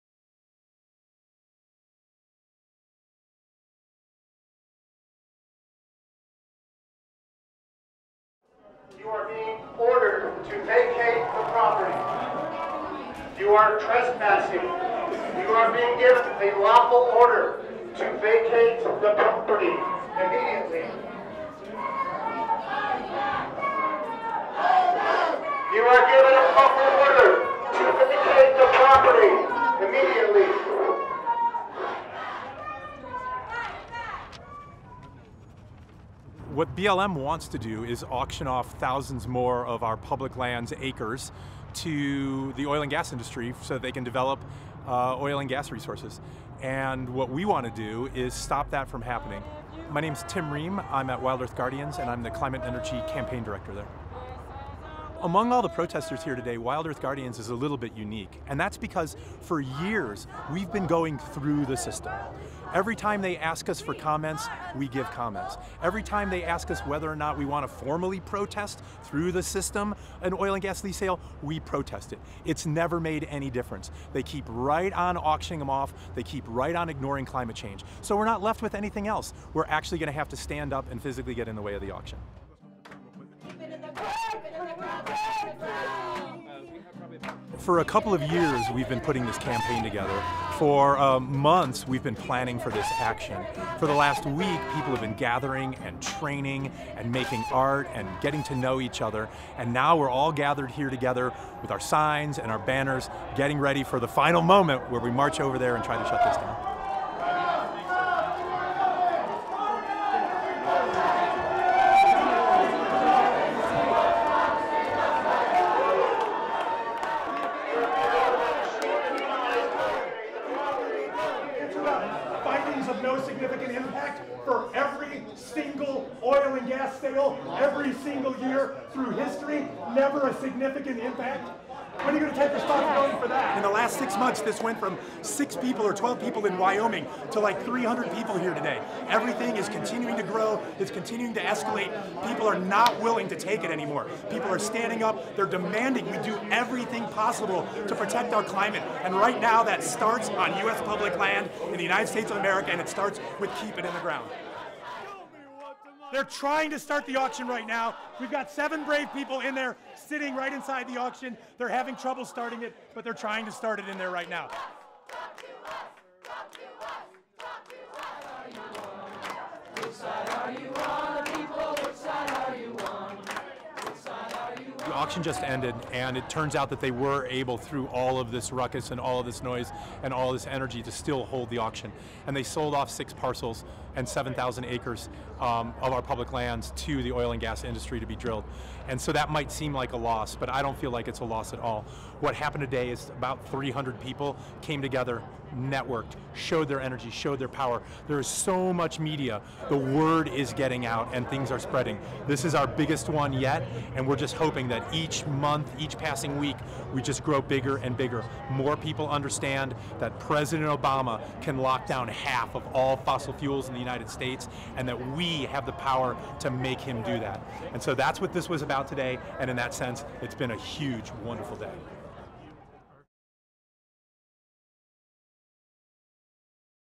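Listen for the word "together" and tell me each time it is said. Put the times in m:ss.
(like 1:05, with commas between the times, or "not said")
1:29, 1:40, 3:14.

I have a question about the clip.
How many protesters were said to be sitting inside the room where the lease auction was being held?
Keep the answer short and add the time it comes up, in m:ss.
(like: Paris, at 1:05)
7, at 2:38.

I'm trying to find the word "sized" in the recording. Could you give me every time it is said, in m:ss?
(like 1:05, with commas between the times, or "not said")
not said.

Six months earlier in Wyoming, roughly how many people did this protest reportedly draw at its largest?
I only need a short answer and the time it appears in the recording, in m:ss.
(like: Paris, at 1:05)
12, at 2:15.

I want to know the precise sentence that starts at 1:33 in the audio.
For the last week, people have been gathering and training and making art and getting to know each other.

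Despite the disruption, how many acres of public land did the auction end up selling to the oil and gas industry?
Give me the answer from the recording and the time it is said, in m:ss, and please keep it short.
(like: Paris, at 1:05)
7,000 acres, at 3:04.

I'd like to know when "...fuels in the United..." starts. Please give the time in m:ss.
3:33.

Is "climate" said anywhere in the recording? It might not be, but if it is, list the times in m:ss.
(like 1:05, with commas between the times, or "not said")
0:52, 1:17, 2:28.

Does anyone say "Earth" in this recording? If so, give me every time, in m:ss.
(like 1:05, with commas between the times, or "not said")
0:51, 0:56.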